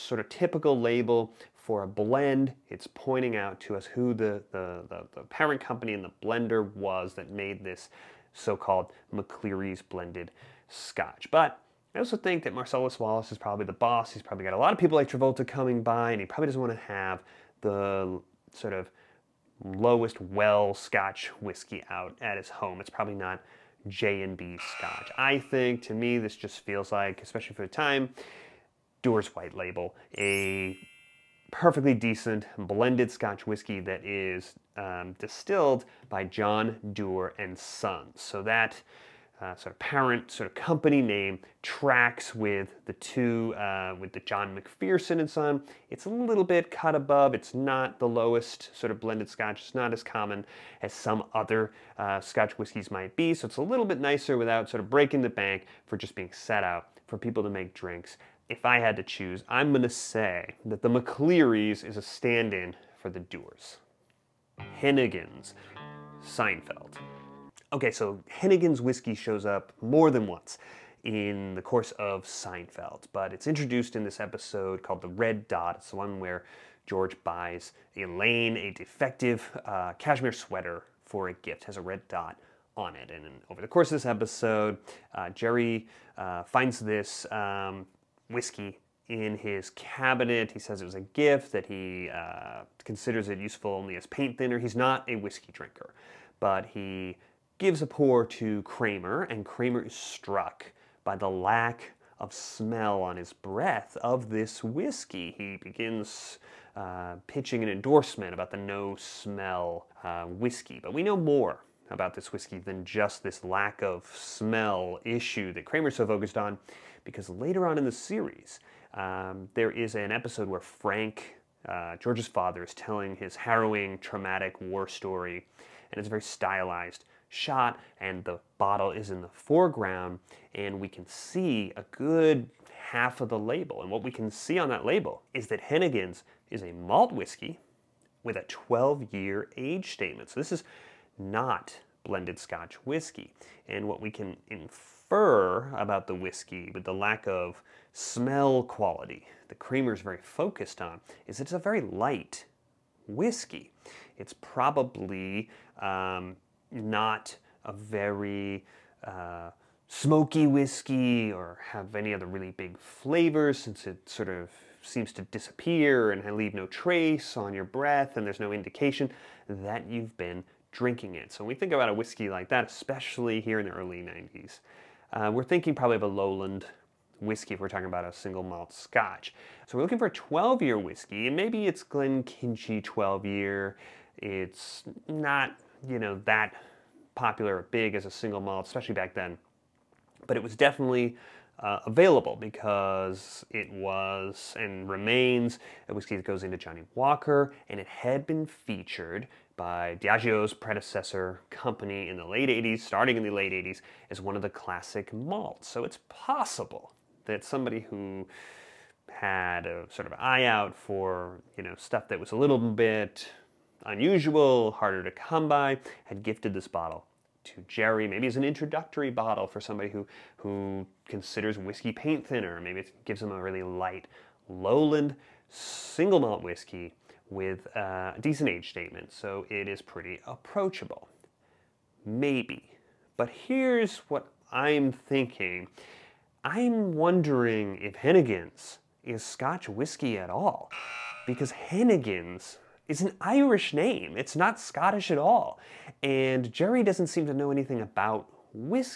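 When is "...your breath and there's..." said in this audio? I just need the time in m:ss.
2:47.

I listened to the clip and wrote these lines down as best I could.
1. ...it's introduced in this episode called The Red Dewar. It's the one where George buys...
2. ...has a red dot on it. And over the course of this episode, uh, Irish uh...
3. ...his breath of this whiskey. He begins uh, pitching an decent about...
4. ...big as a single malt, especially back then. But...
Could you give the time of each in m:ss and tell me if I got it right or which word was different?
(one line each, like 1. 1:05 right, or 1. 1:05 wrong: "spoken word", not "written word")
1. 1:13 wrong: "Dot", not "Dewar"
2. 1:21 wrong: "Jerry", not "Irish"
3. 1:43 wrong: "endorsement", not "decent"
4. 3:07 right.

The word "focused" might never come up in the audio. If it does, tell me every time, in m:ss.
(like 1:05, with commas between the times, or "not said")
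1:56, 2:30.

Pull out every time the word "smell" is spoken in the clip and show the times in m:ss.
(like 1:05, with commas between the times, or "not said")
1:42, 1:48, 1:54, 2:27.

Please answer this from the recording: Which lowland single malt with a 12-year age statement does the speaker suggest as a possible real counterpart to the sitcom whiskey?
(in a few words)
Glenkinchie 12.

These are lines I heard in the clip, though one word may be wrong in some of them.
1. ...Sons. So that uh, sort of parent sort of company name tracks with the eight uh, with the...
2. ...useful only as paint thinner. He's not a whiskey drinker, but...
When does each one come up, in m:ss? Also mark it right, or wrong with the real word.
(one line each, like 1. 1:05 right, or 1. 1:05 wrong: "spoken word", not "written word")
1. 0:37 wrong: "two", not "eight"
2. 1:33 right.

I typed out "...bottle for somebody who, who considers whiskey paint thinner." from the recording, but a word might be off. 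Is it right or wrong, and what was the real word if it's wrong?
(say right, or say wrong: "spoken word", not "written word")
right.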